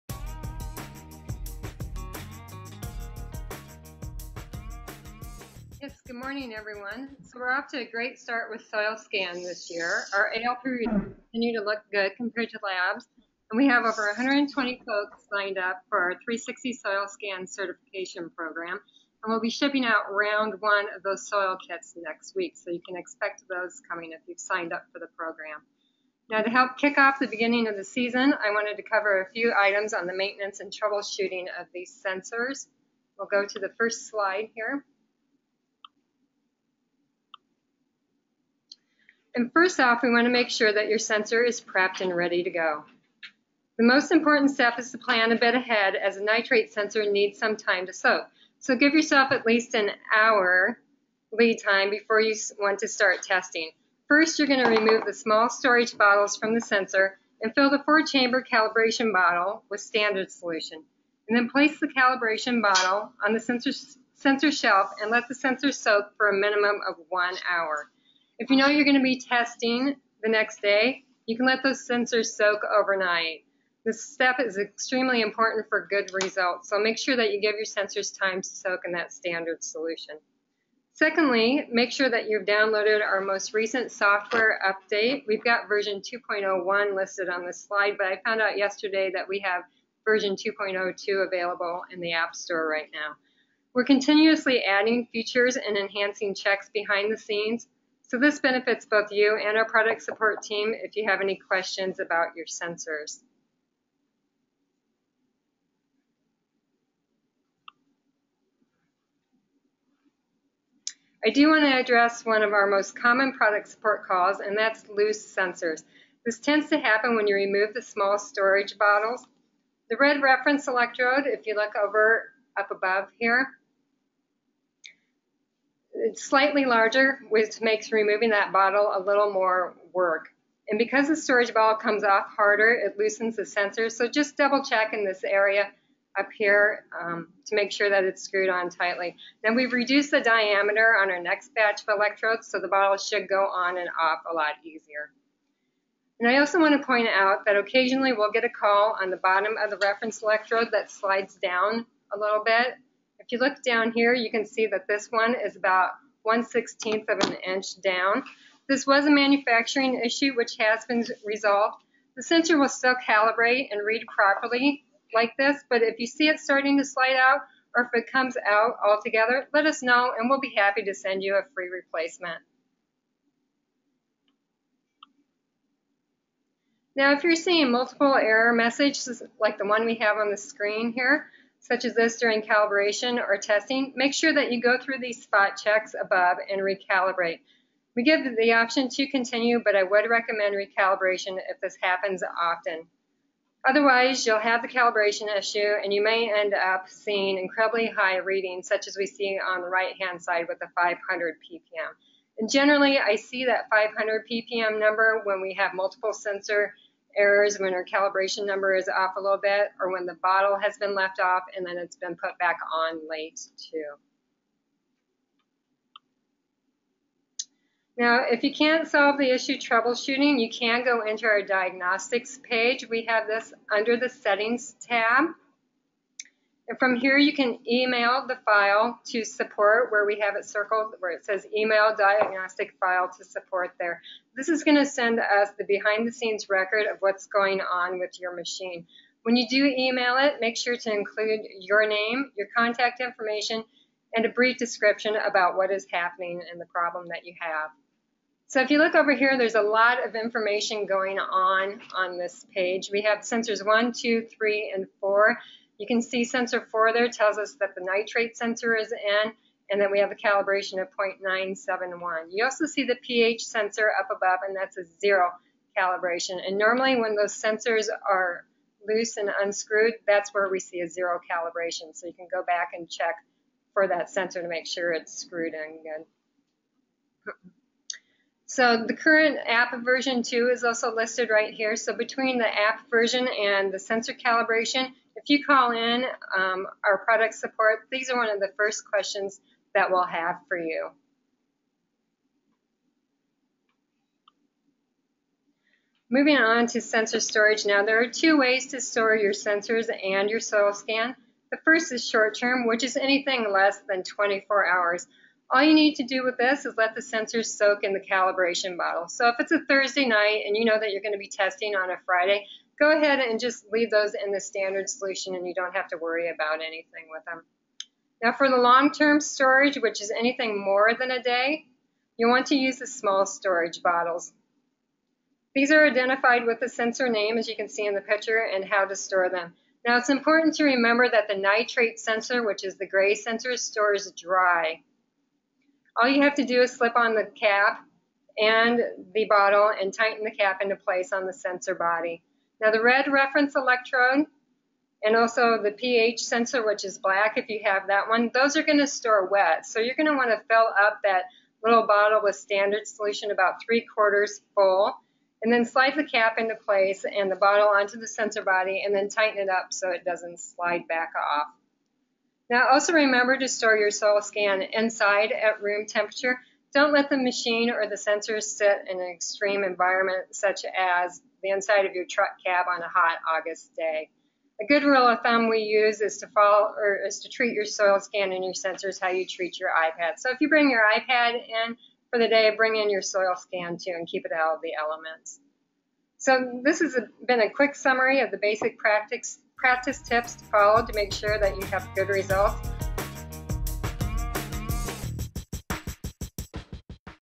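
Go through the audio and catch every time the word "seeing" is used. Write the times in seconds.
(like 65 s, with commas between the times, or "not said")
177 s, 196 s.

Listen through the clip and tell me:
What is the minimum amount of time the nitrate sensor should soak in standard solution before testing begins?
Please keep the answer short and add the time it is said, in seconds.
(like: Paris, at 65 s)
1 hour, at 67 s.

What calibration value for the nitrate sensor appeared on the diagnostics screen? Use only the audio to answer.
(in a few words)
0.971.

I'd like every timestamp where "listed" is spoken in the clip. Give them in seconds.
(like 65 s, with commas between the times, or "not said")
86 s, 280 s.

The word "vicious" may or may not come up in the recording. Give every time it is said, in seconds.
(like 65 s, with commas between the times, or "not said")
not said.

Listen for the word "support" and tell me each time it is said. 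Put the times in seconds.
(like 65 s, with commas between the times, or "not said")
100 s, 113 s, 229 s, 233 s, 287 s.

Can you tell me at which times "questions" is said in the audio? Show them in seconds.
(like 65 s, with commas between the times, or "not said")
101 s, 288 s.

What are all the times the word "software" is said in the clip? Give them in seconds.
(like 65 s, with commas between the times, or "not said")
83 s.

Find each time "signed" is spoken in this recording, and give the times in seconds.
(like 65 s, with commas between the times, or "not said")
15 s, 24 s.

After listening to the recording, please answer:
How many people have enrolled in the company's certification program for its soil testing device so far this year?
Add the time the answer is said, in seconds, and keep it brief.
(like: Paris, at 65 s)
over 120, at 13 s.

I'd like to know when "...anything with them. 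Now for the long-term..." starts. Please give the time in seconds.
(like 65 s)
316 s.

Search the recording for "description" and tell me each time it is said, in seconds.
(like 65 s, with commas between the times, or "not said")
244 s.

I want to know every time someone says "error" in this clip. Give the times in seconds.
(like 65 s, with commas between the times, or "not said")
178 s, 207 s.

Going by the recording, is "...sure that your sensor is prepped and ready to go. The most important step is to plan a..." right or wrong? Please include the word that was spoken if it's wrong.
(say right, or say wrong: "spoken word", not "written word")
right.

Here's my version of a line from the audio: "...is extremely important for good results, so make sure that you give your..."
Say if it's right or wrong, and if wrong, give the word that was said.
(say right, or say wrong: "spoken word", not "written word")
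right.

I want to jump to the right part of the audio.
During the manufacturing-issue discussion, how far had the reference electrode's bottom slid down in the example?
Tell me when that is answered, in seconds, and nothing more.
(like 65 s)
156 s.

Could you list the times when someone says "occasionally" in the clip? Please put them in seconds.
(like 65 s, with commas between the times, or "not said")
147 s.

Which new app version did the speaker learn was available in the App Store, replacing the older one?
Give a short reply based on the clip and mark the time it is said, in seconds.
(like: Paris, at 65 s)
2.02, at 90 s.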